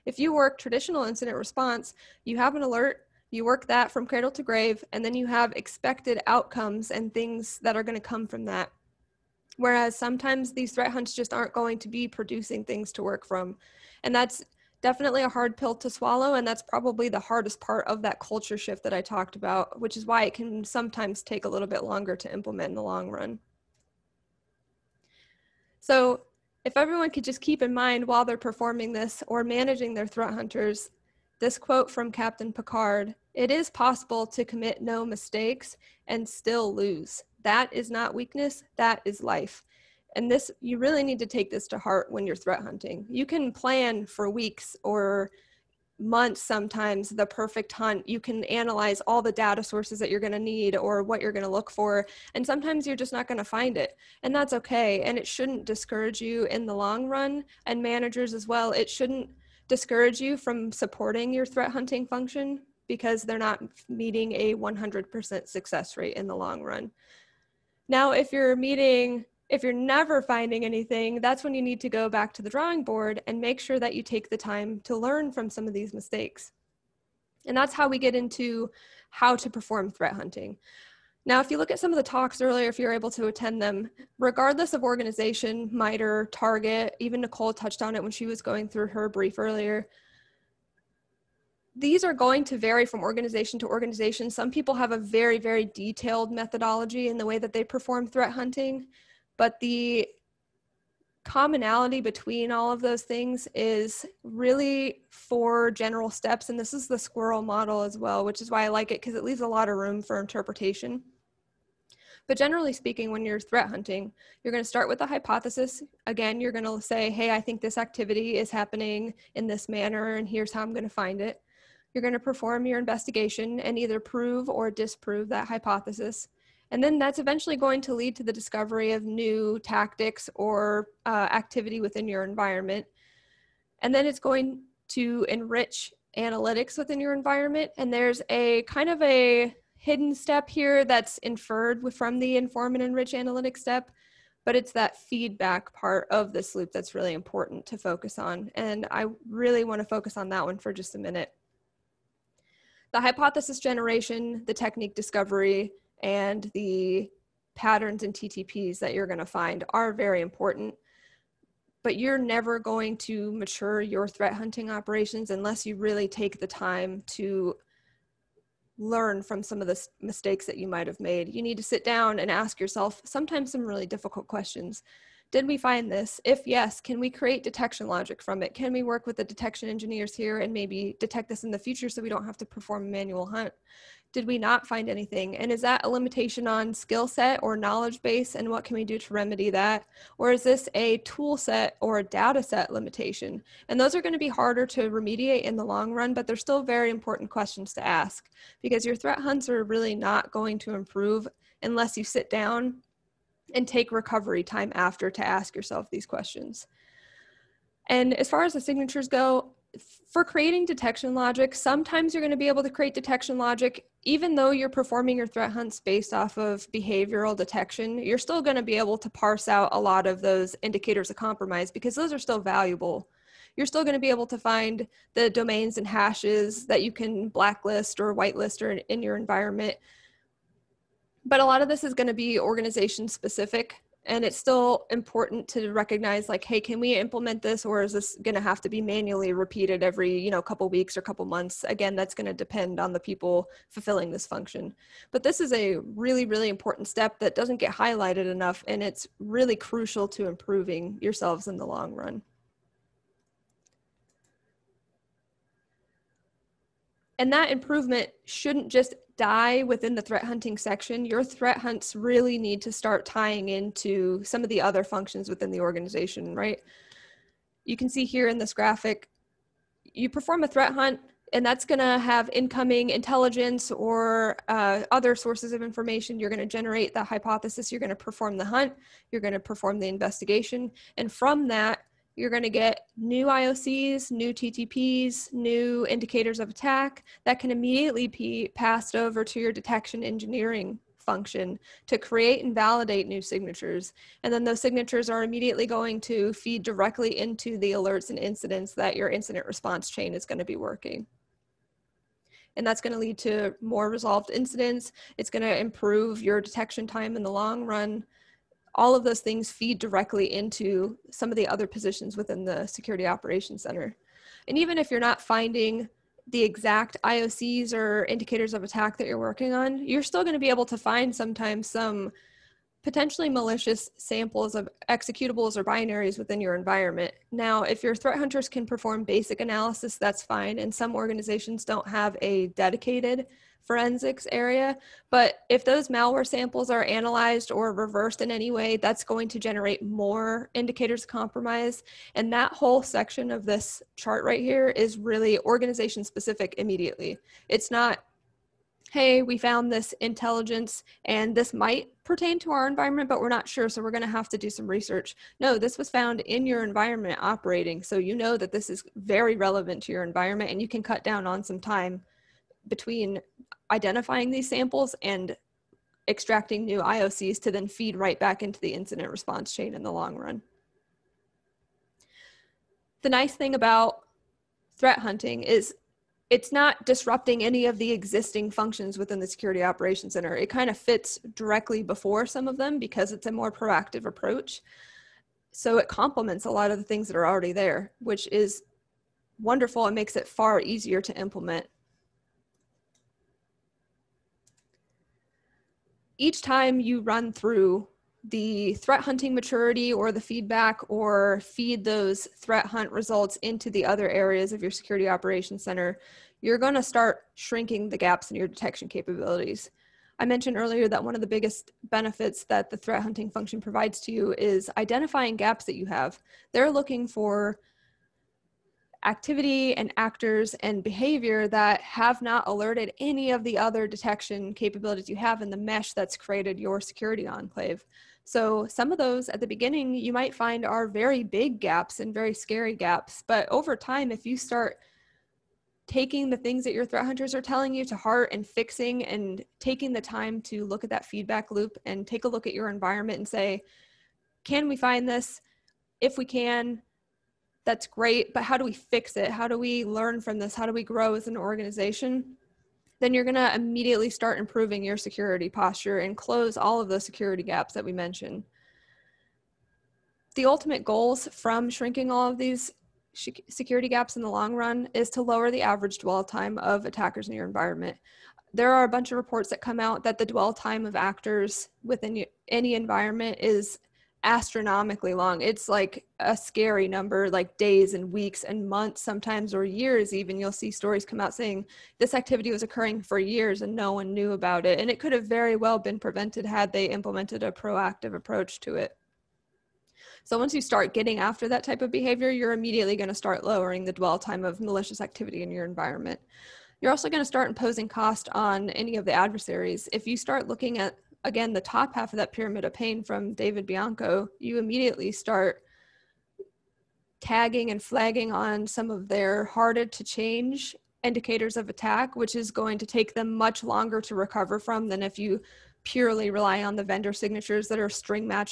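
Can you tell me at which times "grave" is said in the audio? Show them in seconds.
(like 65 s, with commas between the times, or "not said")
4 s.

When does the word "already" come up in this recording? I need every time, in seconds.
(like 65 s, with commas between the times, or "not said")
387 s.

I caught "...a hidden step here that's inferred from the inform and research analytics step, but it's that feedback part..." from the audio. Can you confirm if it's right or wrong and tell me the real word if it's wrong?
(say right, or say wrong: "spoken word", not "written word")
wrong: "enrich", not "research".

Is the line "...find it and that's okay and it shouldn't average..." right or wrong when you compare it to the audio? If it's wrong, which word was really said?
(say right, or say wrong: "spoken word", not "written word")
wrong: "discourage", not "average".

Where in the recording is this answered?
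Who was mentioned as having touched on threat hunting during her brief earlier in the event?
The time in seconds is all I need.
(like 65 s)
87 s.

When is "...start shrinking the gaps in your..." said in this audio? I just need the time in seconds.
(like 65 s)
406 s.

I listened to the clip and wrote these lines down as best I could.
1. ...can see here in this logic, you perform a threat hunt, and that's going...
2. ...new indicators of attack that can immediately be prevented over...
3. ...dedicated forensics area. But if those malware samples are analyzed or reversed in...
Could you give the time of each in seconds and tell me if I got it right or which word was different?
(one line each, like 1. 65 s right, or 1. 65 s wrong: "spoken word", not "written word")
1. 267 s wrong: "graphic", not "logic"
2. 285 s wrong: "passed", not "prevented"
3. 332 s right.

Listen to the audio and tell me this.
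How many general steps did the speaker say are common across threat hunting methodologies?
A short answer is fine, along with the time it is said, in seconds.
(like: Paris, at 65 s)
4, at 105 s.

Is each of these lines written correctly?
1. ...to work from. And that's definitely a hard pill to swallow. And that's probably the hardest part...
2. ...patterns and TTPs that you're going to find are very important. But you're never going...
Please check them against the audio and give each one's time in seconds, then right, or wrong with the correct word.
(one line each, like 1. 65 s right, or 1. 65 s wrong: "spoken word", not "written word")
1. 12 s right
2. 157 s right.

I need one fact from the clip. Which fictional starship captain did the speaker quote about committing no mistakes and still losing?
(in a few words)
Captain Picard.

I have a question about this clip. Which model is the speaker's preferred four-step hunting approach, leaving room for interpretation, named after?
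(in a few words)
Sqrrl.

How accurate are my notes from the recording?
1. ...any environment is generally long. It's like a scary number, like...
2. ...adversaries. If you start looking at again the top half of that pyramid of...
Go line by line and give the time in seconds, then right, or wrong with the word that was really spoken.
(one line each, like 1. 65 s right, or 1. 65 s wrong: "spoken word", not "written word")
1. 472 s wrong: "astronomically", not "generally"
2. 499 s right.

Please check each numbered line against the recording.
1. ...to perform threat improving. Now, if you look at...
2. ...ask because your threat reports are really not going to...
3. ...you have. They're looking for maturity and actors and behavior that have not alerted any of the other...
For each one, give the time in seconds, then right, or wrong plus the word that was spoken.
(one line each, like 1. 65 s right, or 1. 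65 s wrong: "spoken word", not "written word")
1. 79 s wrong: "hunting", not "improving"
2. 197 s wrong: "hunts", not "reports"
3. 415 s wrong: "activity", not "maturity".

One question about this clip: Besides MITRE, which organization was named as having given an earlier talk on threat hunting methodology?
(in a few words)
Target.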